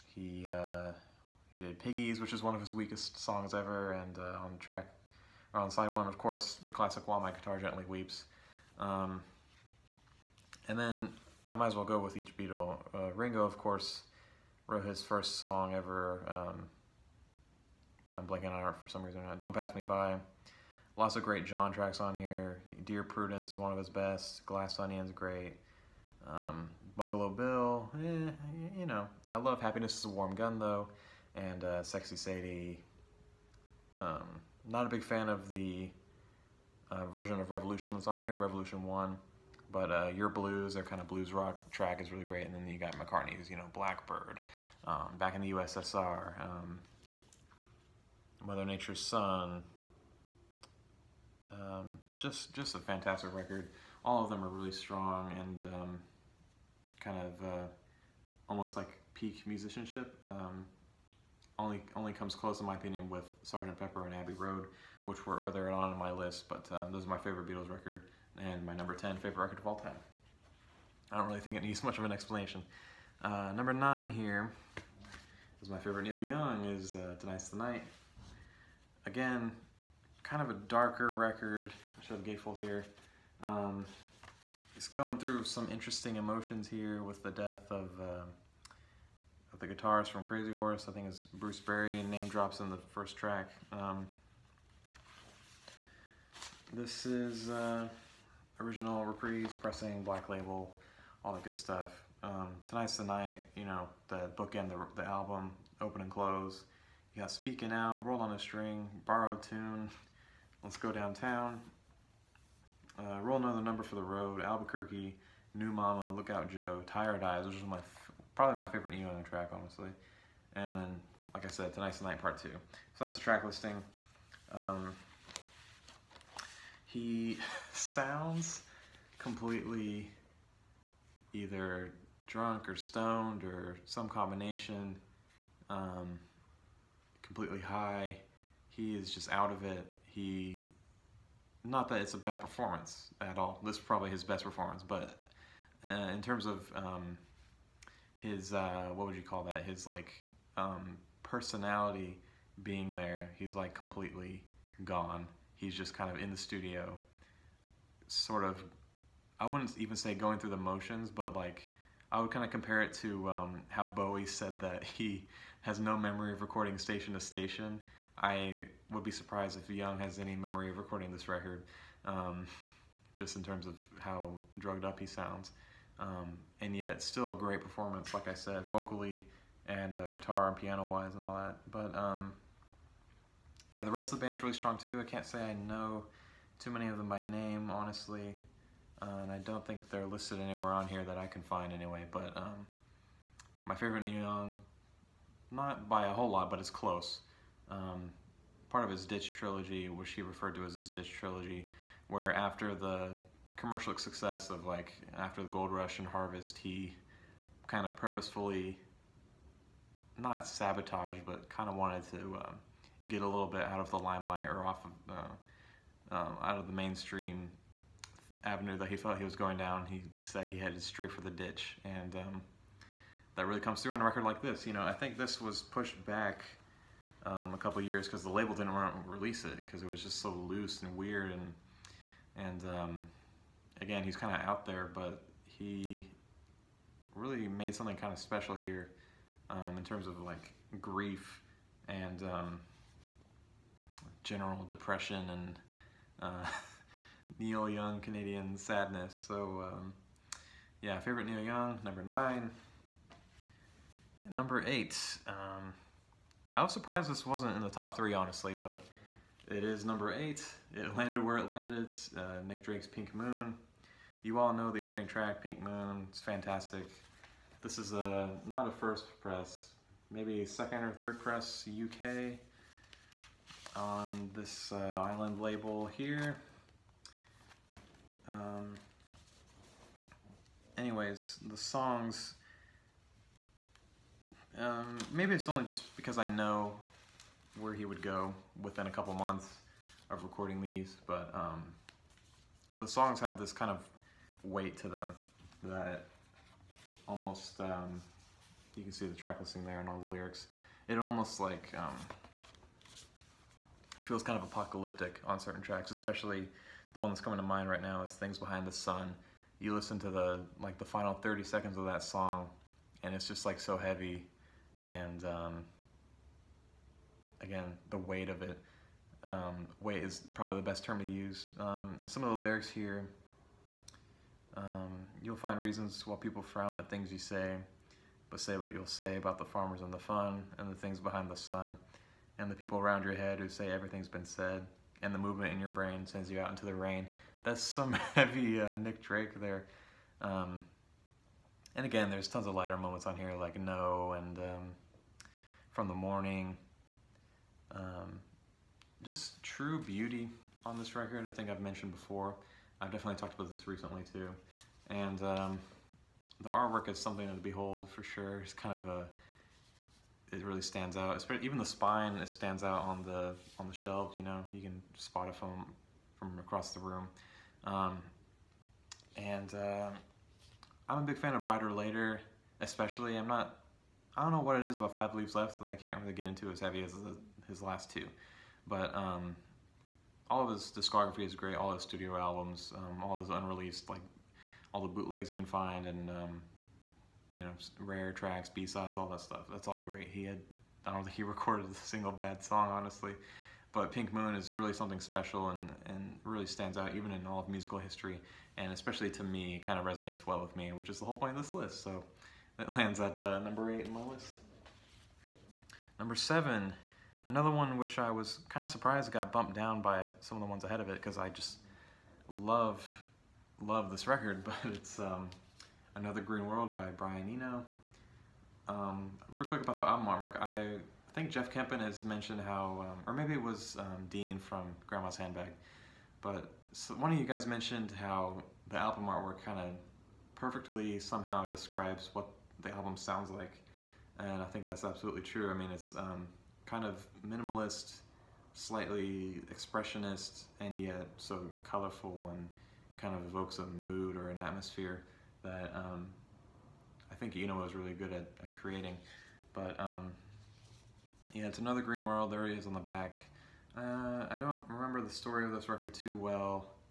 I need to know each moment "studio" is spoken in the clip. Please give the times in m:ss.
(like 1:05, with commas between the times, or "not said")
2:36, 6:21.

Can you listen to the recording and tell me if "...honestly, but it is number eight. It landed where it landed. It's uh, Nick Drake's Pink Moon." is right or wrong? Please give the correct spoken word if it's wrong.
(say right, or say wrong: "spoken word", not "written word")
right.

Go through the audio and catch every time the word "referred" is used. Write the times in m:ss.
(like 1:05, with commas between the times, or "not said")
3:20.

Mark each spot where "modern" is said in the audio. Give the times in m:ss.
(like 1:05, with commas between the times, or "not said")
not said.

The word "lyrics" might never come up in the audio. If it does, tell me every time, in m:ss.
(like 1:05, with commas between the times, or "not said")
5:00, 5:22.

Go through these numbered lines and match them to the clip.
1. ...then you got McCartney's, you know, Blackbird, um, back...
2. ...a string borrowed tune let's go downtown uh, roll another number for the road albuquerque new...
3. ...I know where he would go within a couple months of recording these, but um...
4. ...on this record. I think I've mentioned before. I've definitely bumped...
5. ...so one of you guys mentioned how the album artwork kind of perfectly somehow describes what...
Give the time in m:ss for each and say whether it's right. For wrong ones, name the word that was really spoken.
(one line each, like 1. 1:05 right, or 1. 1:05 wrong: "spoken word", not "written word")
1. 0:42 right
2. 1:48 right
3. 4:46 right
4. 5:50 wrong: "talked", not "bumped"
5. 7:06 right.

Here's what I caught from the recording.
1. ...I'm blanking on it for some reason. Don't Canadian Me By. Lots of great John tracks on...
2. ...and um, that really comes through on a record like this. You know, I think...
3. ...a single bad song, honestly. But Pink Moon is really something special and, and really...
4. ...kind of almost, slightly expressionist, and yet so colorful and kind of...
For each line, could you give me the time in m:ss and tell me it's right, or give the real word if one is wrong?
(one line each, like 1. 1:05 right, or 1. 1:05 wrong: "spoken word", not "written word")
1. 0:18 wrong: "Pass", not "Canadian"
2. 3:41 right
3. 6:31 right
4. 7:16 wrong: "minimalist", not "almost".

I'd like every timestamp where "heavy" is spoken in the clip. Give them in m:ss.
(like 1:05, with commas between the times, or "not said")
5:13, 5:38, 6:16.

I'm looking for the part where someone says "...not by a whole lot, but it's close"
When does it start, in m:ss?
3:15.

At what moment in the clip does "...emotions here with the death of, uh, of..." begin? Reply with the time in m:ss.
1:26.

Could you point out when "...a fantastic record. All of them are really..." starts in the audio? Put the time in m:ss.
0:52.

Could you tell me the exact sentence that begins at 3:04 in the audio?
I can't say I know too many of them by name, honestly.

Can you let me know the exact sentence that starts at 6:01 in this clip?
even the spine it stands out on the on the shelves.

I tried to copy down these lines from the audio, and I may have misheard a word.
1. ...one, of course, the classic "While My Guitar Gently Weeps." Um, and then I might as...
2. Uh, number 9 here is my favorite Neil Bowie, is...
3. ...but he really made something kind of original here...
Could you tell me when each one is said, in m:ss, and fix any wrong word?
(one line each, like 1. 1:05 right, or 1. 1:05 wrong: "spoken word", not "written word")
1. 0:05 right
2. 1:13 wrong: "Young", not "Bowie"
3. 3:54 wrong: "special", not "original".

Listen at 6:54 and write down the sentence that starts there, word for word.
Um, Another Green World by Brian Eno.